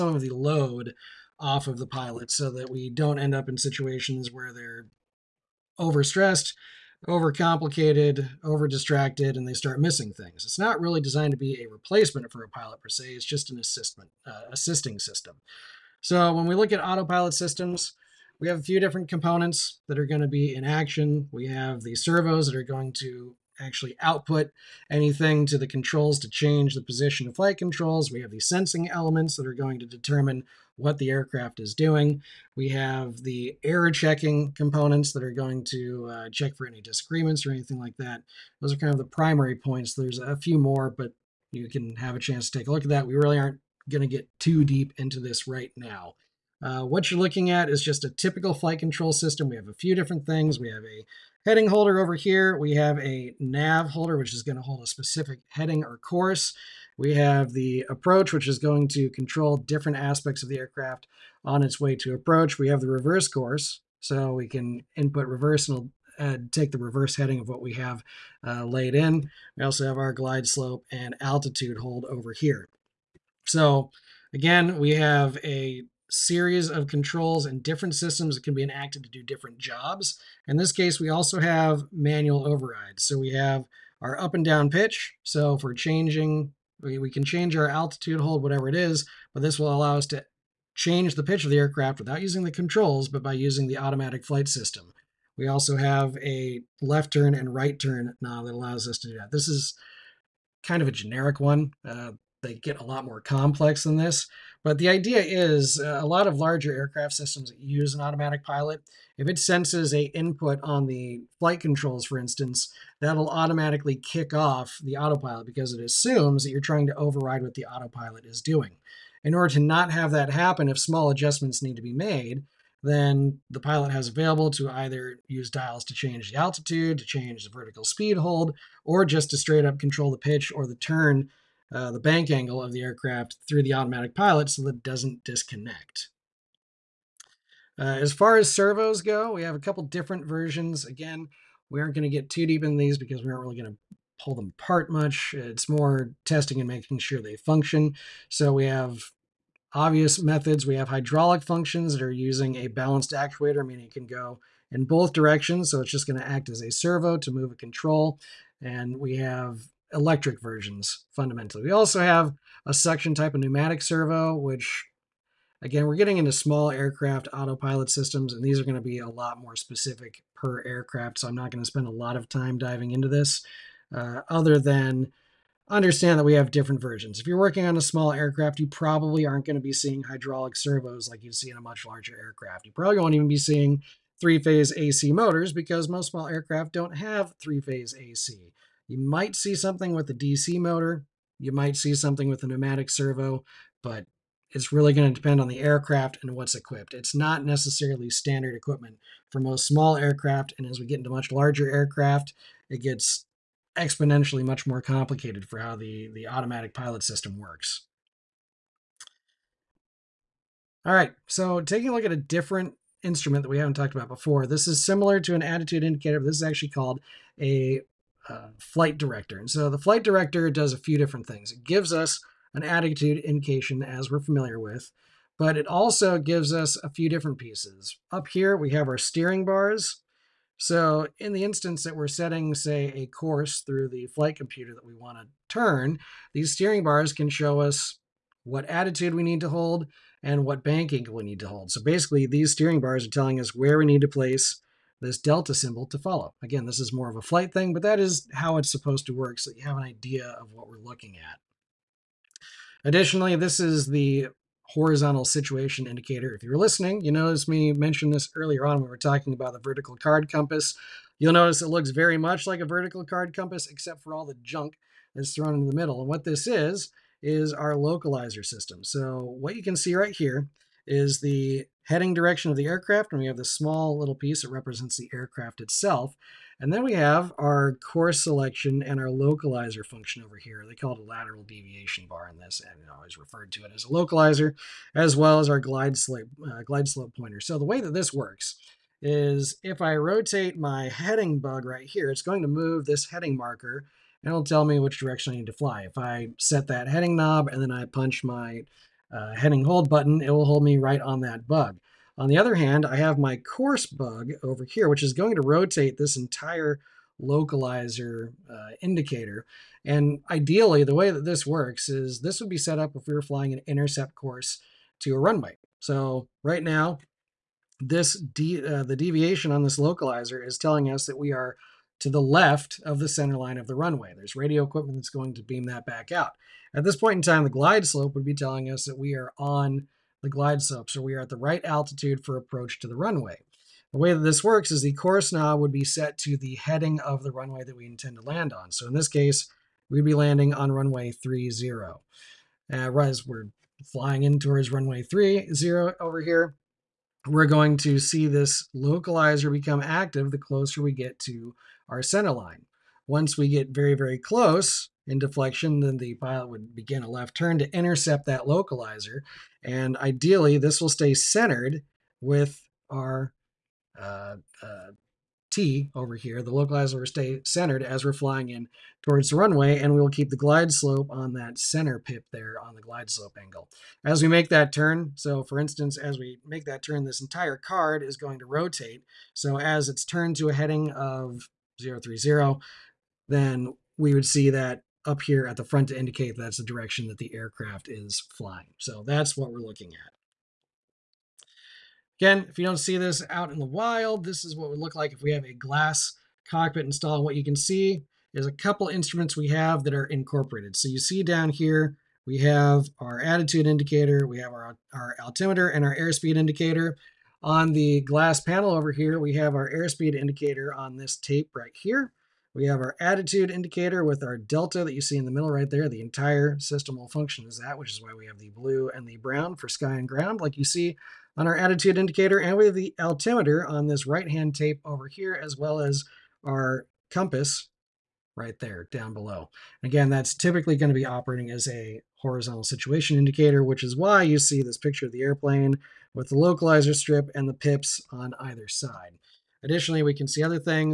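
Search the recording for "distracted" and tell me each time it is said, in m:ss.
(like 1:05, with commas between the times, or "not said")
0:08.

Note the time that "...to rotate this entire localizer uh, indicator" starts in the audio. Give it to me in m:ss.
5:05.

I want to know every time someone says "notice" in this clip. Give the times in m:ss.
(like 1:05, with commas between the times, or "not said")
4:17, 4:21.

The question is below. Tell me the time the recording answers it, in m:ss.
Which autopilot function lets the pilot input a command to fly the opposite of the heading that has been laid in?
1:02.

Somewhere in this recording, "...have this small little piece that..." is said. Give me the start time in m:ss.
4:33.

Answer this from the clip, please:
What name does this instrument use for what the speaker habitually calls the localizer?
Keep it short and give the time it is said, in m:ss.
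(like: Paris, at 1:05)
Lateral deviation bar, at 4:41.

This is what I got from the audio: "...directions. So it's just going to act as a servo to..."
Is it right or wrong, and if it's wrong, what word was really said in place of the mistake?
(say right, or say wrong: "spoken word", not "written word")
right.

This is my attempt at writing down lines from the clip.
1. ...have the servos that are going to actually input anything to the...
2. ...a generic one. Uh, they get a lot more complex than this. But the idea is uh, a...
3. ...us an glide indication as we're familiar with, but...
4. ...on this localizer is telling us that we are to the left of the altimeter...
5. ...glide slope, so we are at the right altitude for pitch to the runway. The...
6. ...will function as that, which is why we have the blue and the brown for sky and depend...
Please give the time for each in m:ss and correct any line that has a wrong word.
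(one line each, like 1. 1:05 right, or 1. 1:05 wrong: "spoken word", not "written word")
1. 0:21 wrong: "output", not "input"
2. 1:40 right
3. 3:41 wrong: "attitude", not "glide"
4. 5:19 wrong: "center", not "altimeter"
5. 5:30 wrong: "approach", not "pitch"
6. 6:56 wrong: "ground", not "depend".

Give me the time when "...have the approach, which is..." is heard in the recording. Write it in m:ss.
0:57.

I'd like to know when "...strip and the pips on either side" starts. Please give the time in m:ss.
7:16.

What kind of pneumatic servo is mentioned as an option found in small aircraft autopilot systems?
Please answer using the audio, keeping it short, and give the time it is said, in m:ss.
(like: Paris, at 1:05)
Suction type, at 2:42.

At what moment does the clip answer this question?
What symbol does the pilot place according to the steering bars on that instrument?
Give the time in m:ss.
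4:05.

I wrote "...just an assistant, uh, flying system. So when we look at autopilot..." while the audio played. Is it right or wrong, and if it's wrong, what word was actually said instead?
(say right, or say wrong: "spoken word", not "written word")
wrong: "assisting", not "flying".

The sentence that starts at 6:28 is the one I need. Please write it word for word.
So that's what we're looking at.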